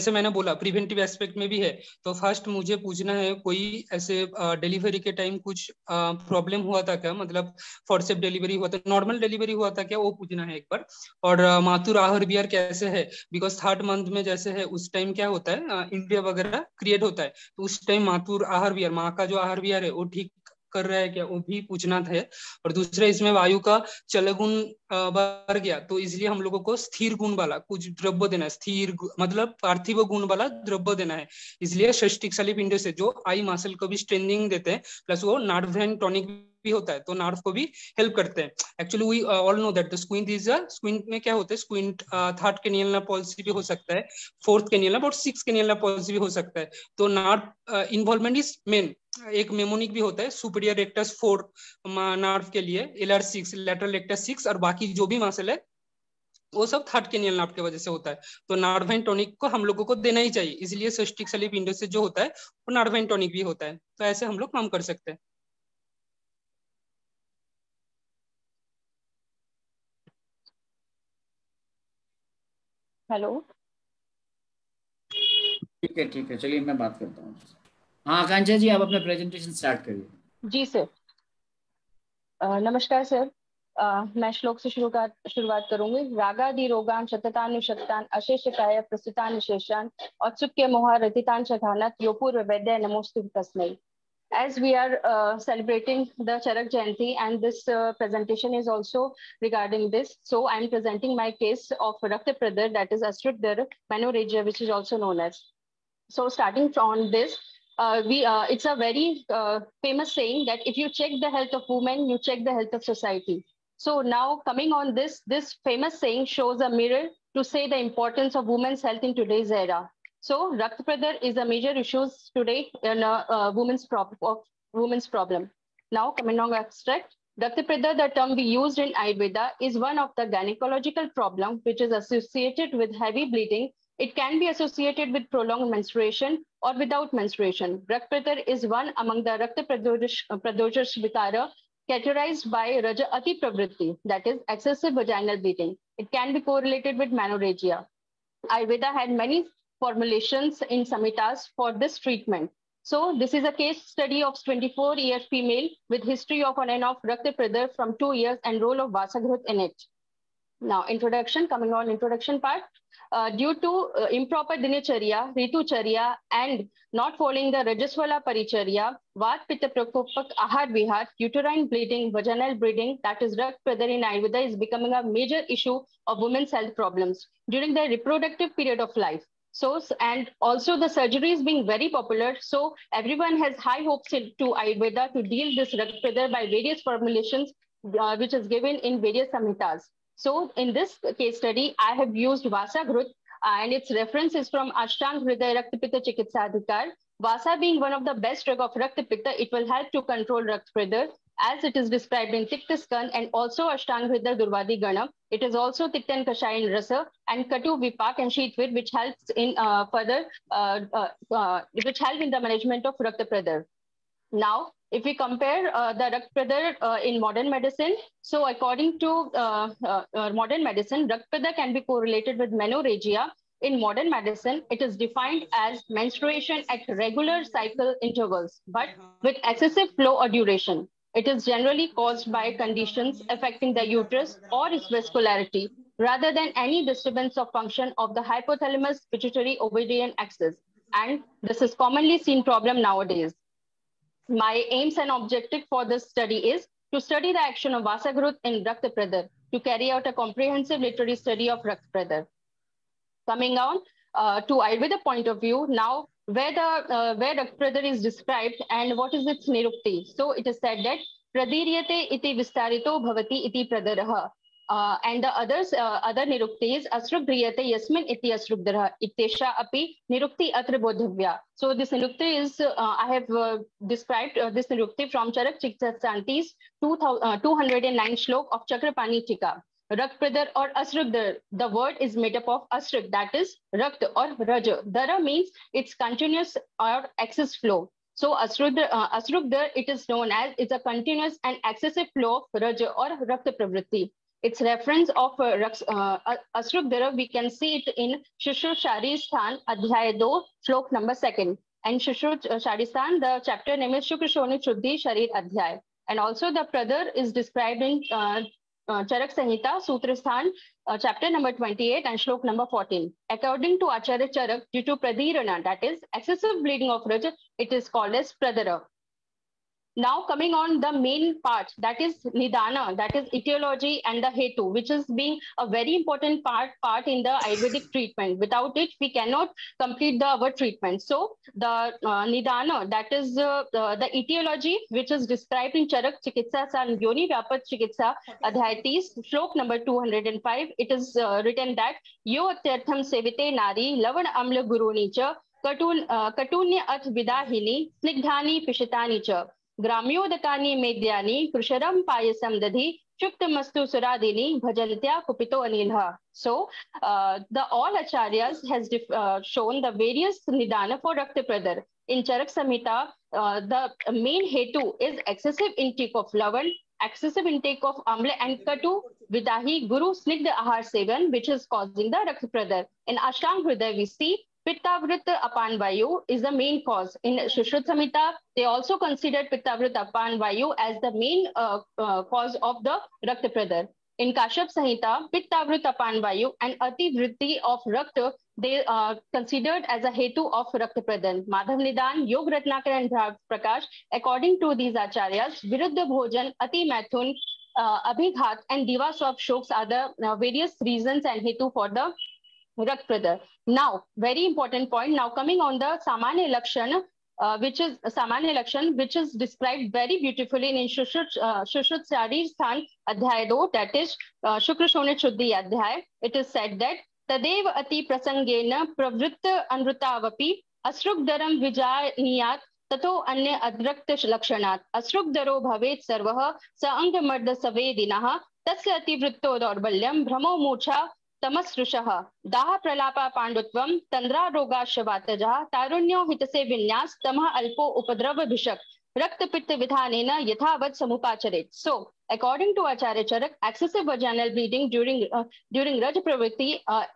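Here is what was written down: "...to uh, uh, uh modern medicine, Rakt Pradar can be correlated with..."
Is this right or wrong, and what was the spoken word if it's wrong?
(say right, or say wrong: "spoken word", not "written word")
right.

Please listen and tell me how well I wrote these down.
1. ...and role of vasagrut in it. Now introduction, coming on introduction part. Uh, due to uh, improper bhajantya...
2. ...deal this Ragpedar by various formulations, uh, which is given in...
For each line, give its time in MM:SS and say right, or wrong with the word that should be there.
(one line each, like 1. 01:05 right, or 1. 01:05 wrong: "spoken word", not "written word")
1. 02:38 wrong: "dinacharya", not "bhajantya"
2. 03:05 right.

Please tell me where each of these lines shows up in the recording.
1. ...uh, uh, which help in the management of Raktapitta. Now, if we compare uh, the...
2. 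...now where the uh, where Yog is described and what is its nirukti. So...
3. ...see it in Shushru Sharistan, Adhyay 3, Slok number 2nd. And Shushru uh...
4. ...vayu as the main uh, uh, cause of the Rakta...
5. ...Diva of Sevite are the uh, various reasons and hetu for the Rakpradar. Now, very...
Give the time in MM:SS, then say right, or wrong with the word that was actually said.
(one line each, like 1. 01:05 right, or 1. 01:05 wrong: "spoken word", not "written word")
1. 03:30 right
2. 04:15 wrong: "Rakt", not "Yog"
3. 04:57 wrong: "2", not "3"
4. 06:20 right
5. 06:38 wrong: "Shoks", not "Sevite".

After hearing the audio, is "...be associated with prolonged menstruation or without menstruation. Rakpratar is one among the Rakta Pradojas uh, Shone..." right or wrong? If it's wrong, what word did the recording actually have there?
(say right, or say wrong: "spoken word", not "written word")
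wrong: "Vitara", not "Shone".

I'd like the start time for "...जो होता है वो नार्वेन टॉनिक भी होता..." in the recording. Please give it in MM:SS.
01:01.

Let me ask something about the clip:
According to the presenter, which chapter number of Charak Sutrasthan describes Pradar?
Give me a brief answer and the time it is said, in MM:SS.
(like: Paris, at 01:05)
28, at 05:10.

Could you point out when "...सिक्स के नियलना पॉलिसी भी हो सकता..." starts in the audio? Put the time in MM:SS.
00:45.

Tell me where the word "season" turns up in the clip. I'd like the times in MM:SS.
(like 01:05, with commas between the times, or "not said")
not said.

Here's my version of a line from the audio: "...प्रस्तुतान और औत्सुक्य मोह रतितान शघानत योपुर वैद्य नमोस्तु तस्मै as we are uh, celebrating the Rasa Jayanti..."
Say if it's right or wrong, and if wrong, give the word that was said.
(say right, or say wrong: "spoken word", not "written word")
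wrong: "Charak", not "Rasa".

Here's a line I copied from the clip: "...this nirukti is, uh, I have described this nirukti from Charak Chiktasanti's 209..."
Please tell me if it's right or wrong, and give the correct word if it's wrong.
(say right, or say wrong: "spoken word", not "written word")
right.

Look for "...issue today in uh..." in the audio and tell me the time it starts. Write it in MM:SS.
02:01.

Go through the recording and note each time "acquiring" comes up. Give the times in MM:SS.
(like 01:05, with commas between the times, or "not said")
not said.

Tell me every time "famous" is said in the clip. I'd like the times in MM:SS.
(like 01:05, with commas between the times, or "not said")
01:49, 01:55.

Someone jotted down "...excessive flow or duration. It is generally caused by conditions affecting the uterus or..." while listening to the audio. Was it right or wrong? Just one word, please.
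right.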